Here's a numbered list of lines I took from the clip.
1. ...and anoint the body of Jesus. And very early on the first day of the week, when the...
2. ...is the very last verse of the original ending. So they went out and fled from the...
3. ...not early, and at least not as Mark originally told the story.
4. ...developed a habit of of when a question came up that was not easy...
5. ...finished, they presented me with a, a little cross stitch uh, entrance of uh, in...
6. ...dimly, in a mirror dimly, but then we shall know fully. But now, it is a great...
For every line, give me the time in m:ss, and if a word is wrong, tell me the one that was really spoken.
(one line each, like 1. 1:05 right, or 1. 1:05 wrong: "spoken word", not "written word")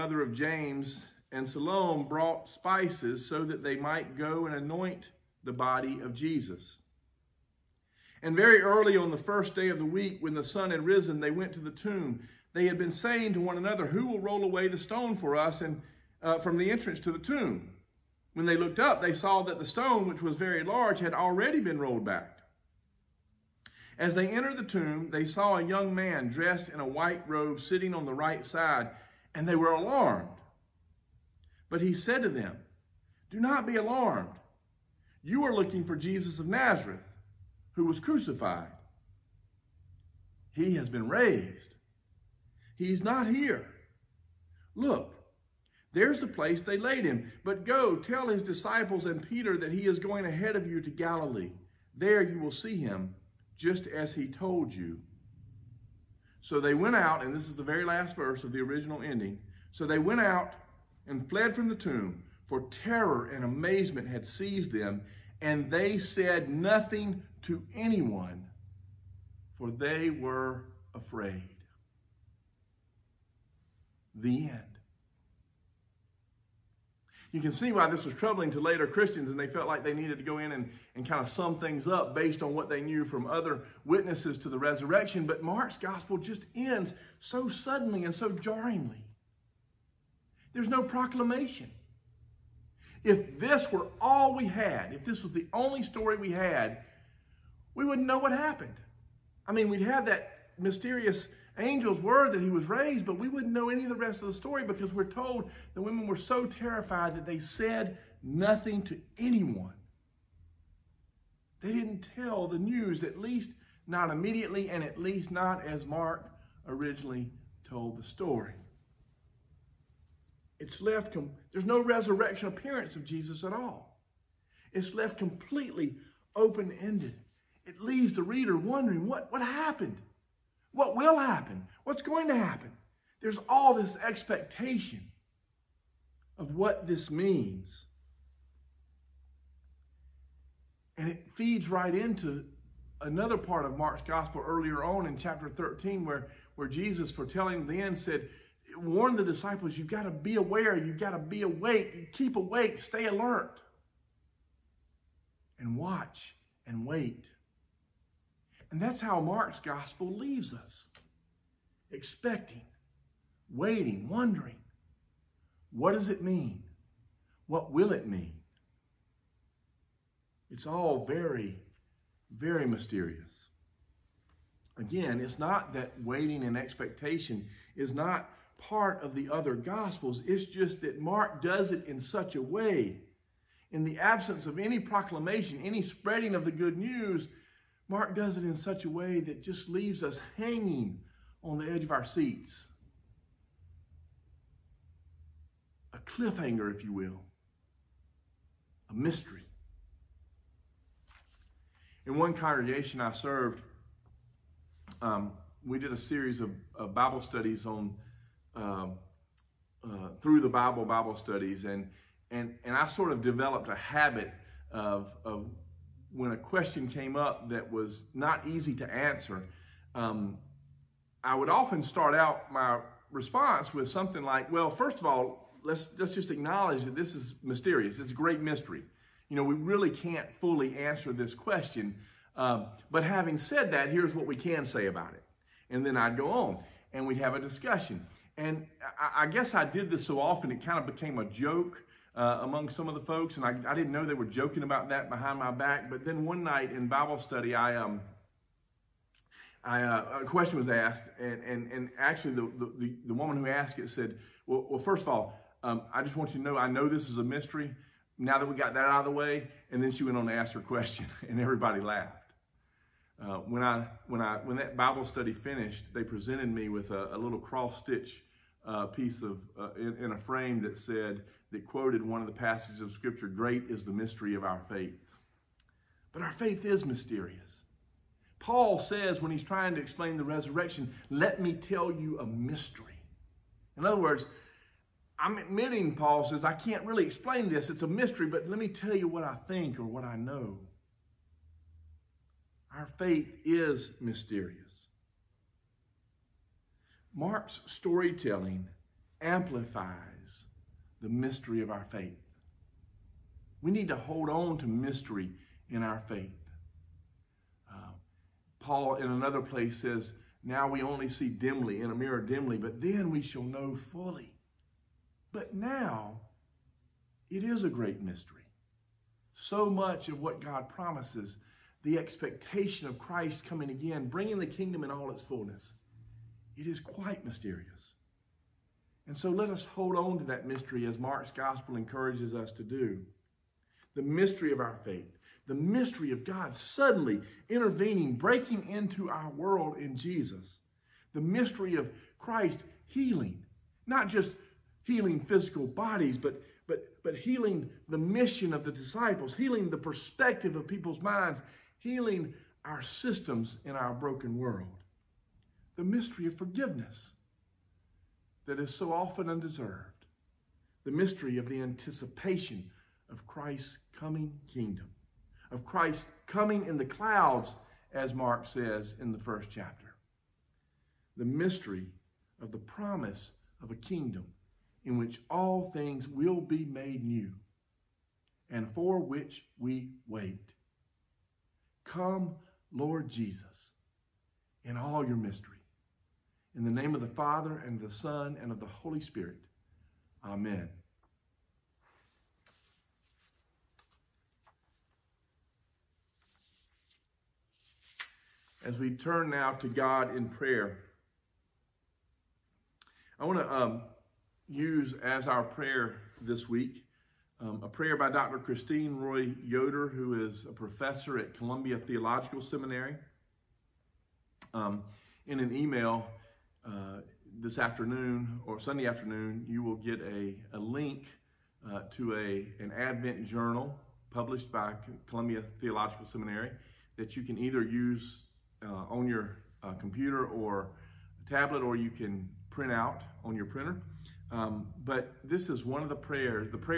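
1. 0:04 right
2. 0:57 right
3. 1:53 wrong: "immediately", not "early"
4. 3:33 right
5. 4:25 wrong: "piece", not "entrance"
6. 5:11 right.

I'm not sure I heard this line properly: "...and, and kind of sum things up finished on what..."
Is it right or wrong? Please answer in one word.
wrong.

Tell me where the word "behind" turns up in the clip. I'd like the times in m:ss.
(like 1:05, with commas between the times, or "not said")
4:05.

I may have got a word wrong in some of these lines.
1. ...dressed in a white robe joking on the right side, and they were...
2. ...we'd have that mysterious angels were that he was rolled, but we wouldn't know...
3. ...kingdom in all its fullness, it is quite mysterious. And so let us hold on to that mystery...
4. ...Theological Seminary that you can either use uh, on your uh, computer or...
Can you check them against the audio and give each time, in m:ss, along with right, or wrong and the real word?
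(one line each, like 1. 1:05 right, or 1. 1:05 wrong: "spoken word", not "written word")
1. 0:26 wrong: "sitting", not "joking"
2. 1:39 wrong: "raised", not "rolled"
3. 5:24 right
4. 7:05 right.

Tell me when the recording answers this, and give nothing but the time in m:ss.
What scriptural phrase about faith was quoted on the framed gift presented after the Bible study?
4:33.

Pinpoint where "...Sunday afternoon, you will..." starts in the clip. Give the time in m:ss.
6:58.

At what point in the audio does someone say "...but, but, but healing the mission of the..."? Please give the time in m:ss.
5:46.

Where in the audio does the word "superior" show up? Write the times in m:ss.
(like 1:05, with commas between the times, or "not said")
not said.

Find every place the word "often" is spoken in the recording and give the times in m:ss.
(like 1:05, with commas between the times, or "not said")
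3:41, 4:00, 5:58.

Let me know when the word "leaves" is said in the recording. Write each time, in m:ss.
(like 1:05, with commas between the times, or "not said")
2:07, 2:40, 3:09.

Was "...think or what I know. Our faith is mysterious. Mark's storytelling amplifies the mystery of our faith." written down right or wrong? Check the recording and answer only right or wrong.
right.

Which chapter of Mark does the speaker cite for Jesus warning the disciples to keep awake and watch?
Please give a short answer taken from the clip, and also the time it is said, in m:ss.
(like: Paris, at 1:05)
chapter 13, at 2:25.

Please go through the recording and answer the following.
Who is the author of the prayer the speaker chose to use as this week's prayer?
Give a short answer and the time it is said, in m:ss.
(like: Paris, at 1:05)
Christine Roy Yoder, at 6:48.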